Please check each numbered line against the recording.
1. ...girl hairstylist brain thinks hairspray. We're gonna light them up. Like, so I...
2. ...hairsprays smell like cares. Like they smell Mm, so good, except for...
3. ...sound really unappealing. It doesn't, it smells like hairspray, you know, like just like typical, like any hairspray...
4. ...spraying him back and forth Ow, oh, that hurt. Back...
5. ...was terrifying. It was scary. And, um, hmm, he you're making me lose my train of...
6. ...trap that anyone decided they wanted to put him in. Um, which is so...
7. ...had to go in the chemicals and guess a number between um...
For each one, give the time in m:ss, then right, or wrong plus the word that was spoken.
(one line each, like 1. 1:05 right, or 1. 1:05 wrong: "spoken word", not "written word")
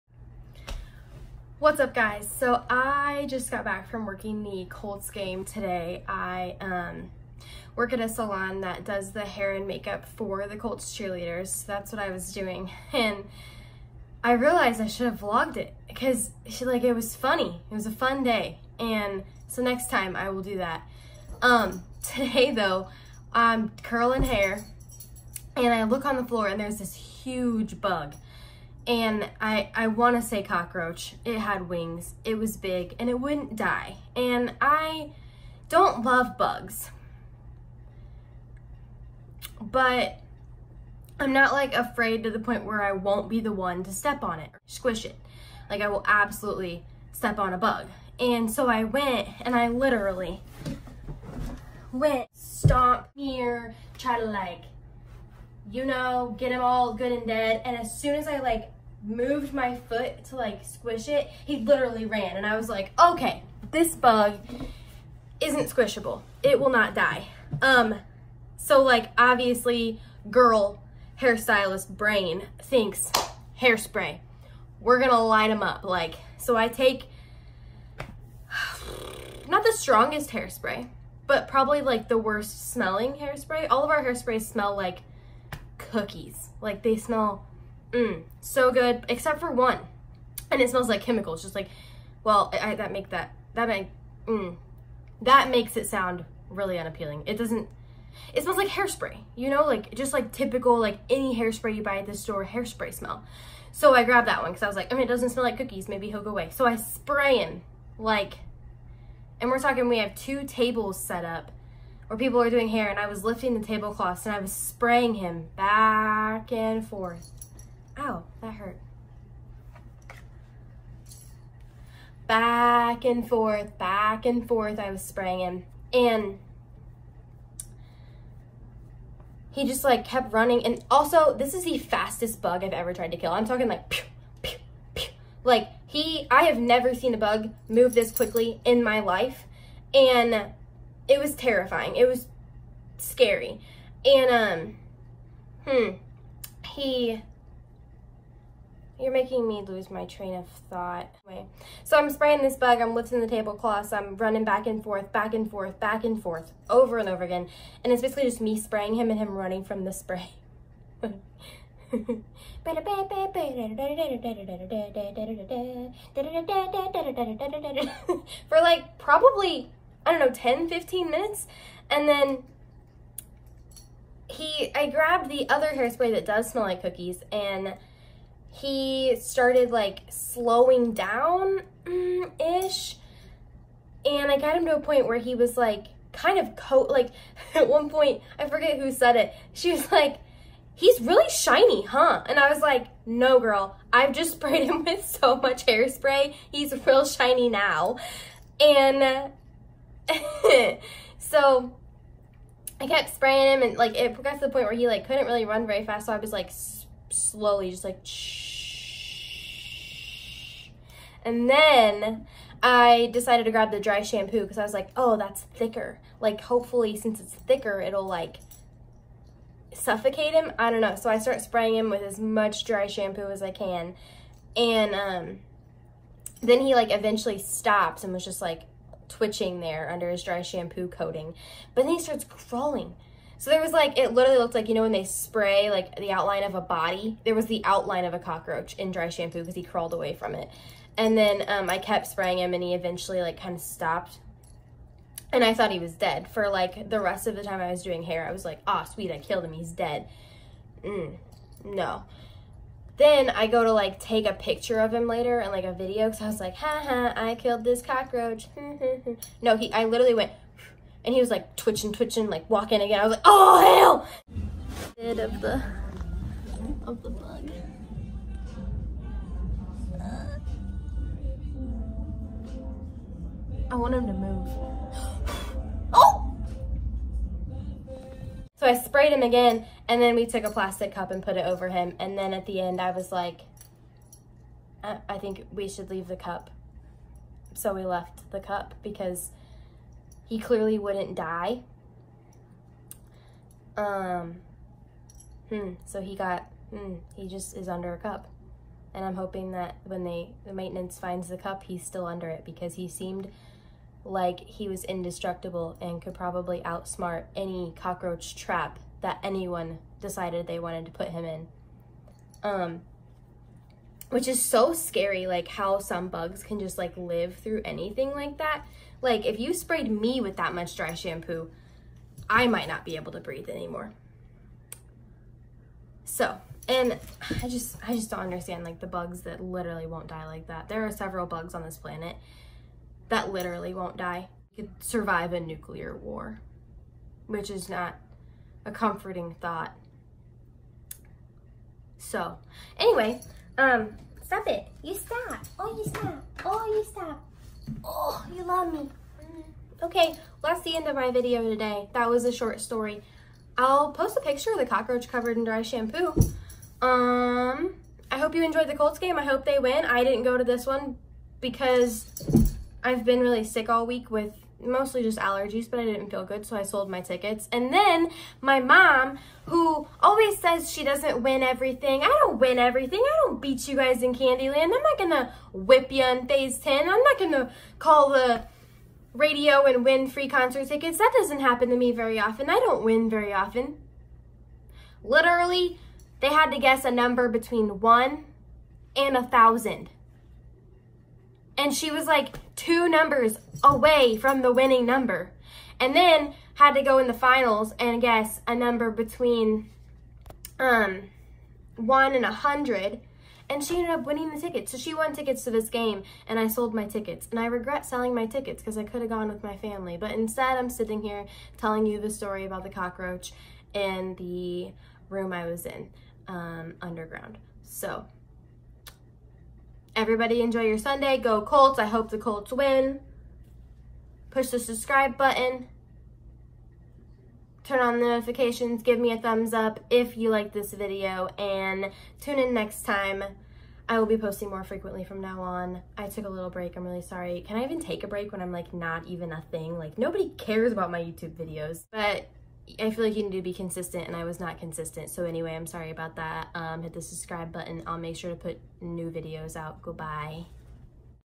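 1. 1:10 right
2. 1:24 wrong: "cookies", not "cares"
3. 1:35 right
4. 1:54 right
5. 2:21 right
6. 5:08 right
7. 6:36 wrong: "finals", not "chemicals".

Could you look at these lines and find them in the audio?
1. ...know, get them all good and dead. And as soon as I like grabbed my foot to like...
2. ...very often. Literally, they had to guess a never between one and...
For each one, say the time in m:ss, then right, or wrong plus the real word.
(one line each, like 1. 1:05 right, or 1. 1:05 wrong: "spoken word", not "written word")
1. 0:55 wrong: "moved", not "grabbed"
2. 6:23 wrong: "number", not "never".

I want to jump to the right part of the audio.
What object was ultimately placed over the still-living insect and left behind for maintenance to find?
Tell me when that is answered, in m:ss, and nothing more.
4:40.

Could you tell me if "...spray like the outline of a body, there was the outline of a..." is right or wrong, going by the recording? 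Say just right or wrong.
right.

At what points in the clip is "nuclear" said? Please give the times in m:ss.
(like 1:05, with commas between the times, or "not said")
5:35.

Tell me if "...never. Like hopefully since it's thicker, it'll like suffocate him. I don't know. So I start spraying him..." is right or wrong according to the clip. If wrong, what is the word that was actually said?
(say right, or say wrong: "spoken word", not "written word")
wrong: "thicker", not "never".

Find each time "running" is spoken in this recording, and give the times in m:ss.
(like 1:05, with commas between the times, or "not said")
2:10, 2:34, 2:39.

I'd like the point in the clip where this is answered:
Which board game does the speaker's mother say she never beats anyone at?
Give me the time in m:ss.
6:14.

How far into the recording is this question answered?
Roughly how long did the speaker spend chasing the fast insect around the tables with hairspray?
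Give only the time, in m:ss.
2:50.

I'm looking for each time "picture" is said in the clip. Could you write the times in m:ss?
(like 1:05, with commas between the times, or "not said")
4:14, 5:54.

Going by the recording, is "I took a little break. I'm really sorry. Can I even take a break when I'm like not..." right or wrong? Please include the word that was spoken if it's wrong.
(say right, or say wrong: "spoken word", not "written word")
right.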